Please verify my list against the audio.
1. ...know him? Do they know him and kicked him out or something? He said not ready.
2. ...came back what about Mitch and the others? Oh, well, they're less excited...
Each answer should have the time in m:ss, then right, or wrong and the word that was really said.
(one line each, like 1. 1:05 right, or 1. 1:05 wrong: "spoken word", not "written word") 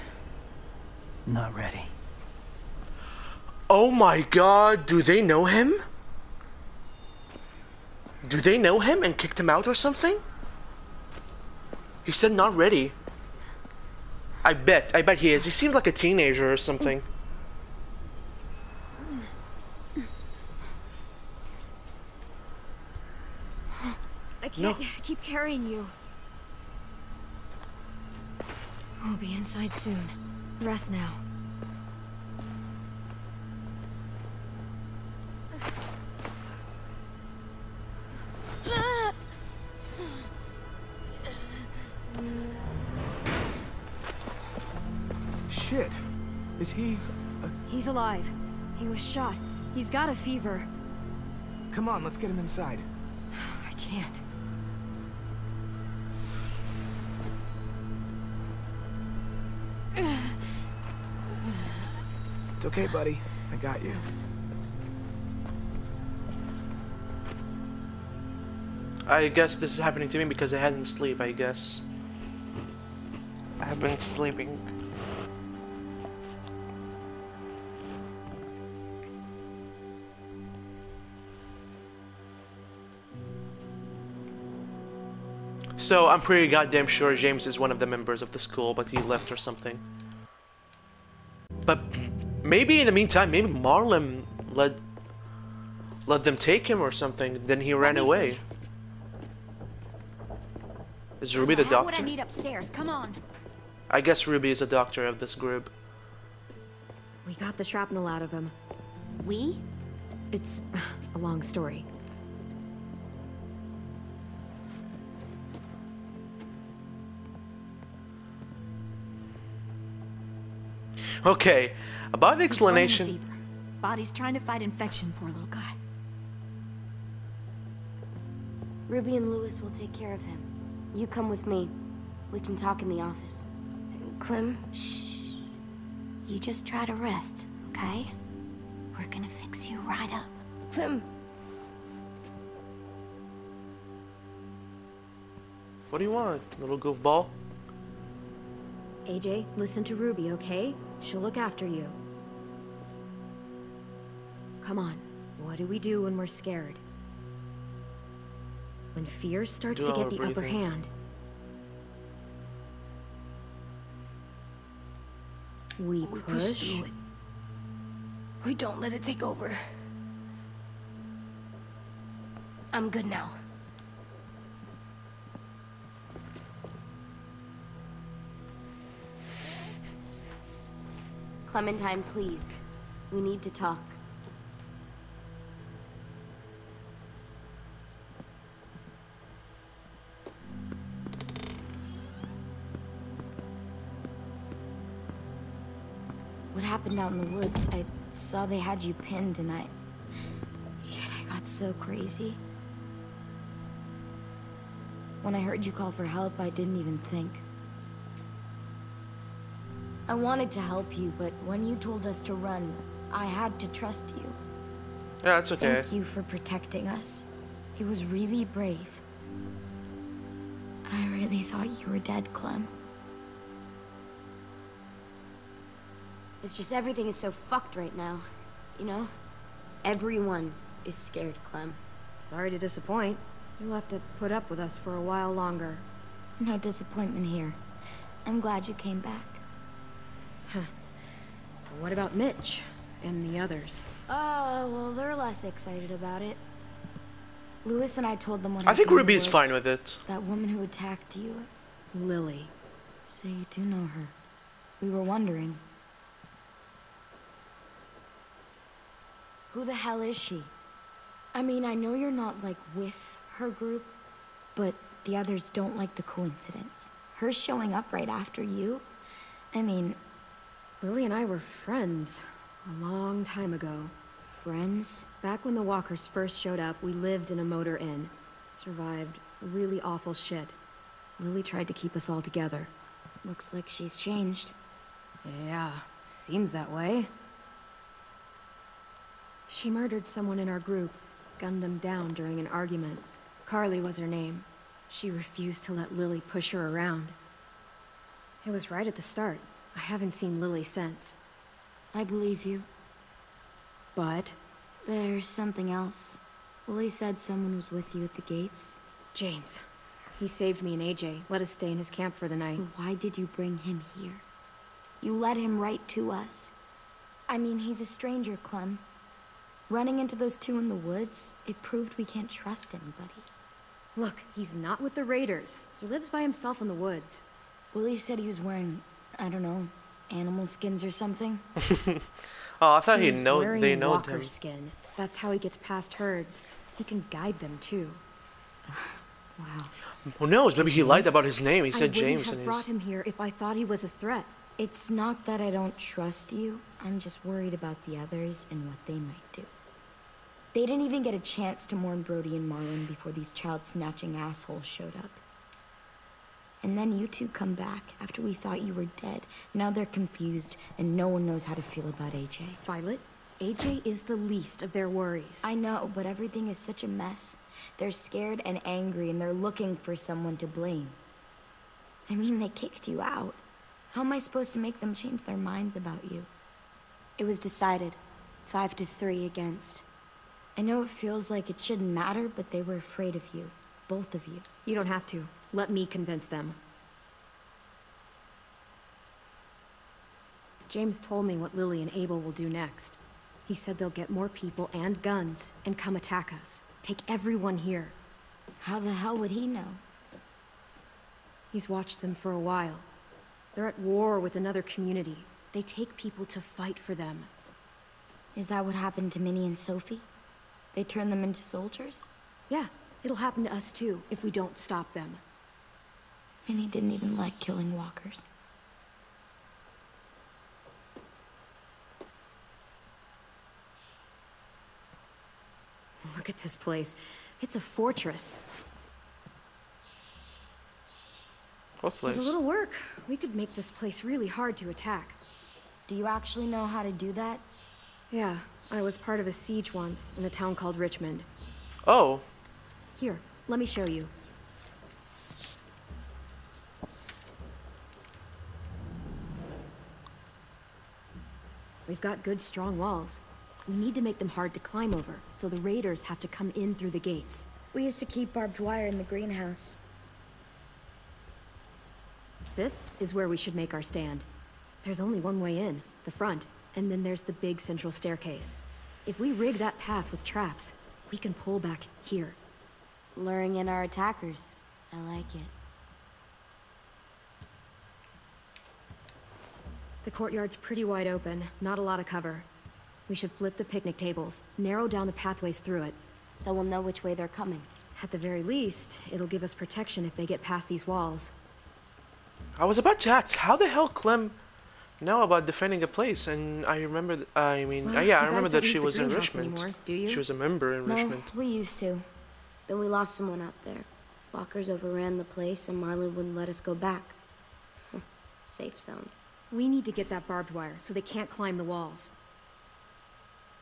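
1. 0:05 right
2. 3:58 right.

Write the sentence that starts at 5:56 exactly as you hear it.
And then you two come back after we thought you were dead.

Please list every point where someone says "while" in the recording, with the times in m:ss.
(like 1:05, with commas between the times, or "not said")
3:55, 6:42.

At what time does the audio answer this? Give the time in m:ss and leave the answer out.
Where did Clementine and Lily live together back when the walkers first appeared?
4:37.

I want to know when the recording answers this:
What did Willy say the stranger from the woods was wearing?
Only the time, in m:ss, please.
5:30.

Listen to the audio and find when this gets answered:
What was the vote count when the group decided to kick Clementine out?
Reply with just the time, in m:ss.
6:18.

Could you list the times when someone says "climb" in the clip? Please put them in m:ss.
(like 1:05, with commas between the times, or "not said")
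7:34, 8:31.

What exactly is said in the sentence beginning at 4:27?
Her showing up right after you?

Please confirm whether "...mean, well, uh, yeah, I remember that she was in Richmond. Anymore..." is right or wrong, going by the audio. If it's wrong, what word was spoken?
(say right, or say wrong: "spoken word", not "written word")
right.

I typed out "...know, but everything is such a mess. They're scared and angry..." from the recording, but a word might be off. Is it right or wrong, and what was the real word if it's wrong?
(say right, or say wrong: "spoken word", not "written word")
right.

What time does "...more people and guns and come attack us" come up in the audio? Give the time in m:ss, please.
6:34.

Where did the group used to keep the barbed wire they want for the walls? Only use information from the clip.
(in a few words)
The greenhouse.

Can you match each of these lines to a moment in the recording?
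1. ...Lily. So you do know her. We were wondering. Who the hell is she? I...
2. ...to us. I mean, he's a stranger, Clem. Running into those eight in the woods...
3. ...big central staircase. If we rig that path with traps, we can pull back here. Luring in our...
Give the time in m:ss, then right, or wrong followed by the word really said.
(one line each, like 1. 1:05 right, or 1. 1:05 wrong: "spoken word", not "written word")
1. 4:11 right
2. 5:15 wrong: "two", not "eight"
3. 7:47 right.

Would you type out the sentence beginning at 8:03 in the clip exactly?
We should flip the picnic tables, narrow down the pathways through it.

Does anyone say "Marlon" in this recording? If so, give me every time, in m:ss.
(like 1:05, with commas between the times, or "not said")
1:33, 5:52, 8:25.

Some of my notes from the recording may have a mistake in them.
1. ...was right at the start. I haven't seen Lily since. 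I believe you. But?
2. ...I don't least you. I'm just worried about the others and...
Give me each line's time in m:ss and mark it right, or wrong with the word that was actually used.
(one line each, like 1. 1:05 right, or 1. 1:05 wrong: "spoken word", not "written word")
1. 4:58 right
2. 5:45 wrong: "trust", not "least".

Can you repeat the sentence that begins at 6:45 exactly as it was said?
They take people to fight for them.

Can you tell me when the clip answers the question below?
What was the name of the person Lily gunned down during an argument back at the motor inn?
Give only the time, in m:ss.
4:53.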